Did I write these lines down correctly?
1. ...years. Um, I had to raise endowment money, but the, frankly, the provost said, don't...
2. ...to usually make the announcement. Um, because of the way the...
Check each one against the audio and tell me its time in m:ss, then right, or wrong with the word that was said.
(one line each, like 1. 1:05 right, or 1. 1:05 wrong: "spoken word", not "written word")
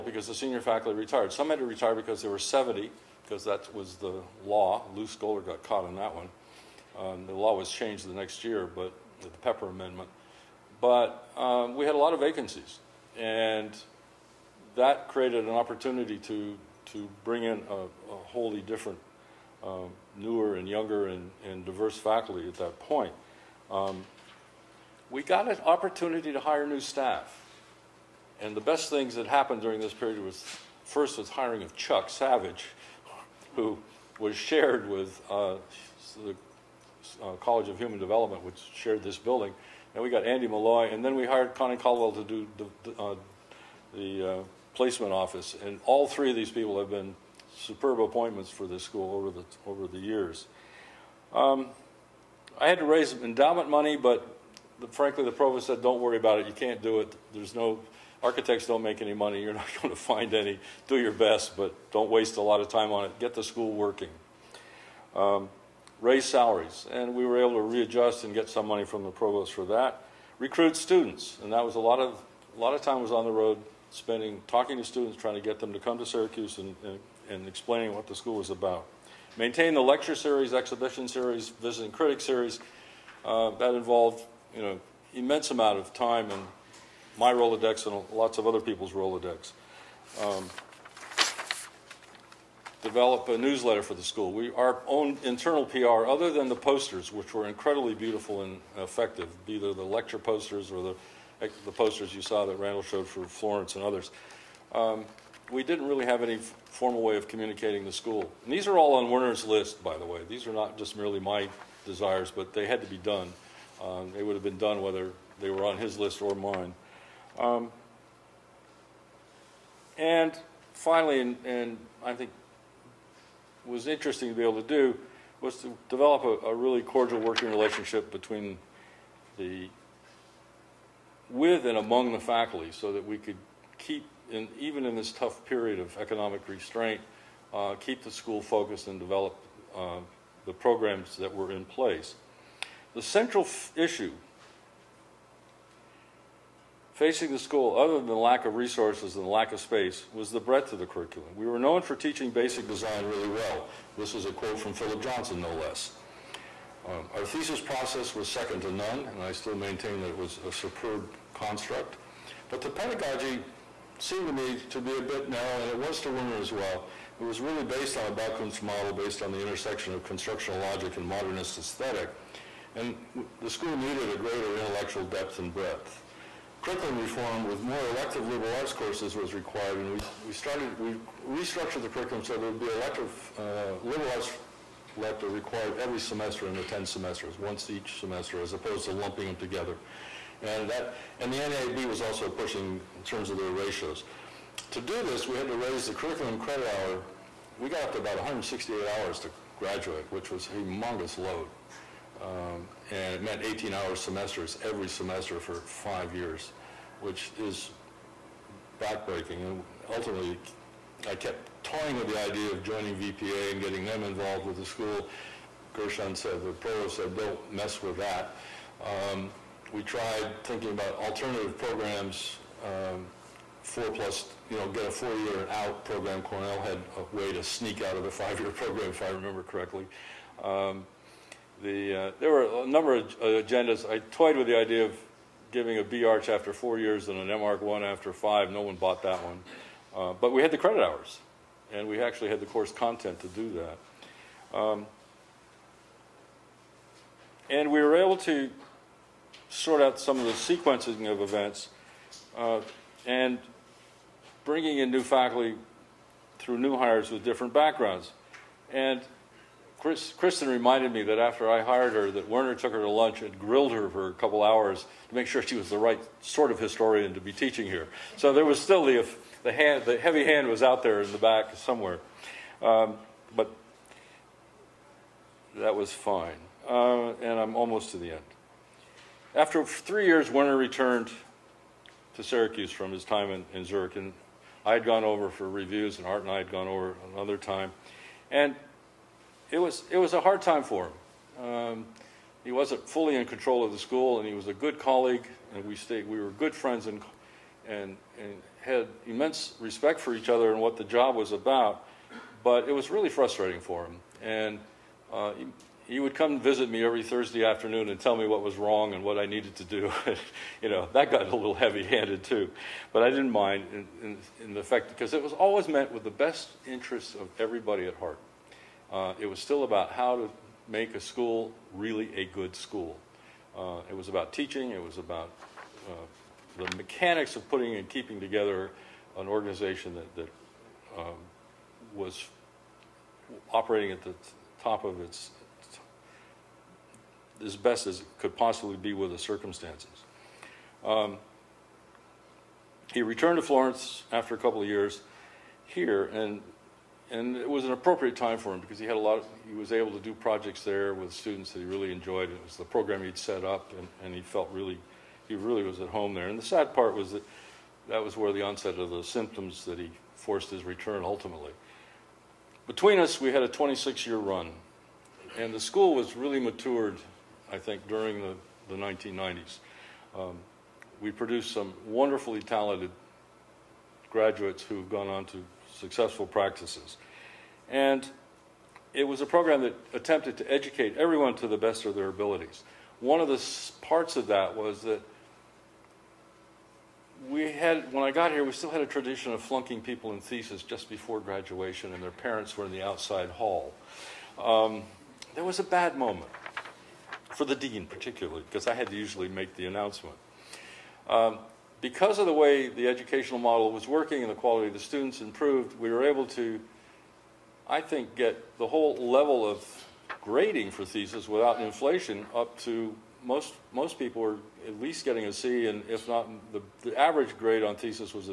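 1. 0:49 right
2. 6:38 right.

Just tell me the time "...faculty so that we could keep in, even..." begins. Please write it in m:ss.
2:12.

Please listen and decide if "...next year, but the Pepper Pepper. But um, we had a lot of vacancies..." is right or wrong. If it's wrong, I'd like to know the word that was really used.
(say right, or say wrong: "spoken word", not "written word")
wrong: "Amendment", not "Pepper".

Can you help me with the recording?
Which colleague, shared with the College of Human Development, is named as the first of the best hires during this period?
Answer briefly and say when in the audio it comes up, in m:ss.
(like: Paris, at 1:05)
Chuck Savage, at 0:31.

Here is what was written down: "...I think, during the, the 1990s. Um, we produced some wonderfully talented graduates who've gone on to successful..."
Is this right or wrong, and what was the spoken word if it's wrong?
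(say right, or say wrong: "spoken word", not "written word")
right.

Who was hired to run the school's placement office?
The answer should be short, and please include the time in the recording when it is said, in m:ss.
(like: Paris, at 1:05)
Connie Caldwell, at 0:41.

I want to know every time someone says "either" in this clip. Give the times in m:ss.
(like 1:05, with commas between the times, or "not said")
1:39.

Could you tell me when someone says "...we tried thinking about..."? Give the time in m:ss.
3:39.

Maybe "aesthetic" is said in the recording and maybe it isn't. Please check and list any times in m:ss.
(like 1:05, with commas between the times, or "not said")
2:51.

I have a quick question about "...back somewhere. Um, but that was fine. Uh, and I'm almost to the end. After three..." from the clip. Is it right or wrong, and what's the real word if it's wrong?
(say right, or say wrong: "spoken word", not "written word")
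right.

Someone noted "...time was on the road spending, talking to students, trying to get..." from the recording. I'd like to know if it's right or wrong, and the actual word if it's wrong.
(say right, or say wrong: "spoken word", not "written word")
right.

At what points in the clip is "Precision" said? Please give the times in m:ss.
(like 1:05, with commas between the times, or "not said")
not said.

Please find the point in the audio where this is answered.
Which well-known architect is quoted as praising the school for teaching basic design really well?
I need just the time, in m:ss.
2:34.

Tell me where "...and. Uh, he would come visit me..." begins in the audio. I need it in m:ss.
5:04.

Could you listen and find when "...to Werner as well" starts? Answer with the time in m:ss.
2:46.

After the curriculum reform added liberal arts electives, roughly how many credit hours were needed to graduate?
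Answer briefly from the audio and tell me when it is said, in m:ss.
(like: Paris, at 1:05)
168, at 3:18.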